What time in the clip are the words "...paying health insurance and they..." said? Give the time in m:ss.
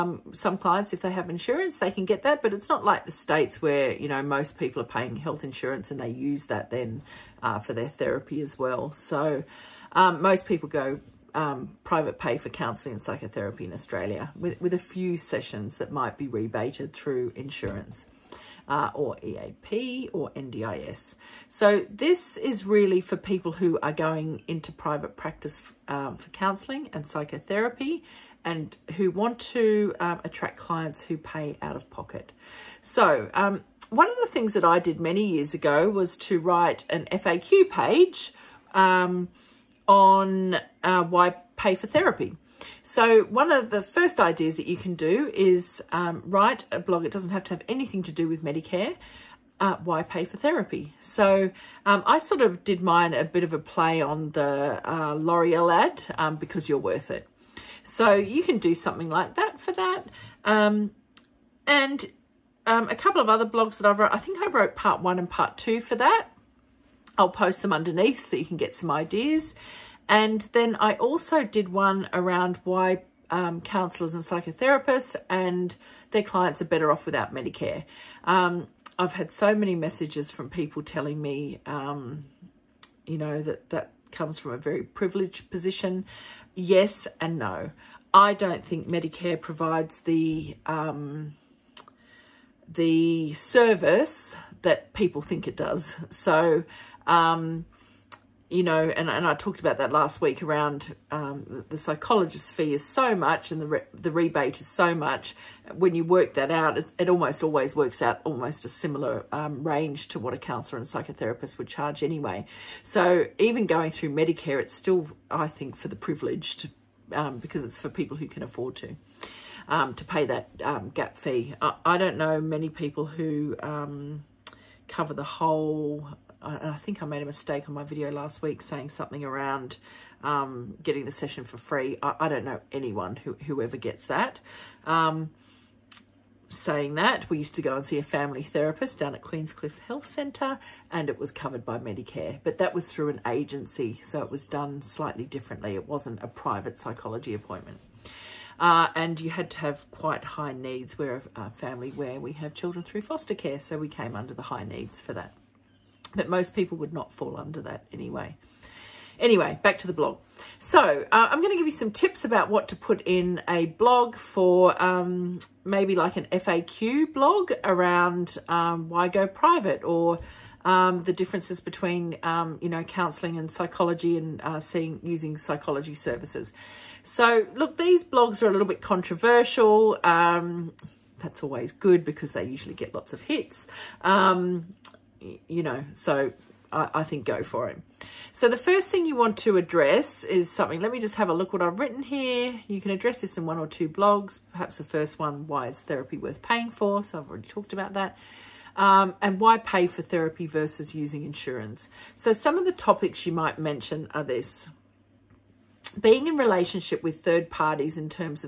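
0:04.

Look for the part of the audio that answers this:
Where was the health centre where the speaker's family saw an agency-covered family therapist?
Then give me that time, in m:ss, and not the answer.
2:19.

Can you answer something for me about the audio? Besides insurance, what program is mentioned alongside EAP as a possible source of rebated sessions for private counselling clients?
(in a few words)
NDIS.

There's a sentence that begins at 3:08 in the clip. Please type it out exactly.
So the first thing you want to address is something.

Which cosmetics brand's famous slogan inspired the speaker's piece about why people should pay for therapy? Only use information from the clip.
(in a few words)
L'Oreal.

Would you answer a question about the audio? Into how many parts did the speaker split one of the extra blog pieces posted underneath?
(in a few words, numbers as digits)
2.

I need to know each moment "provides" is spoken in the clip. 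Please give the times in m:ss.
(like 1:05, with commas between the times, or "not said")
1:29.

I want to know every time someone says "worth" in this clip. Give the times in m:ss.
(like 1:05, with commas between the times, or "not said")
0:56, 3:16.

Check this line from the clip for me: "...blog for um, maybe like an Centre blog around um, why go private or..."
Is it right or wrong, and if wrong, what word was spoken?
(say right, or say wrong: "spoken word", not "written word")
wrong: "FAQ", not "Centre".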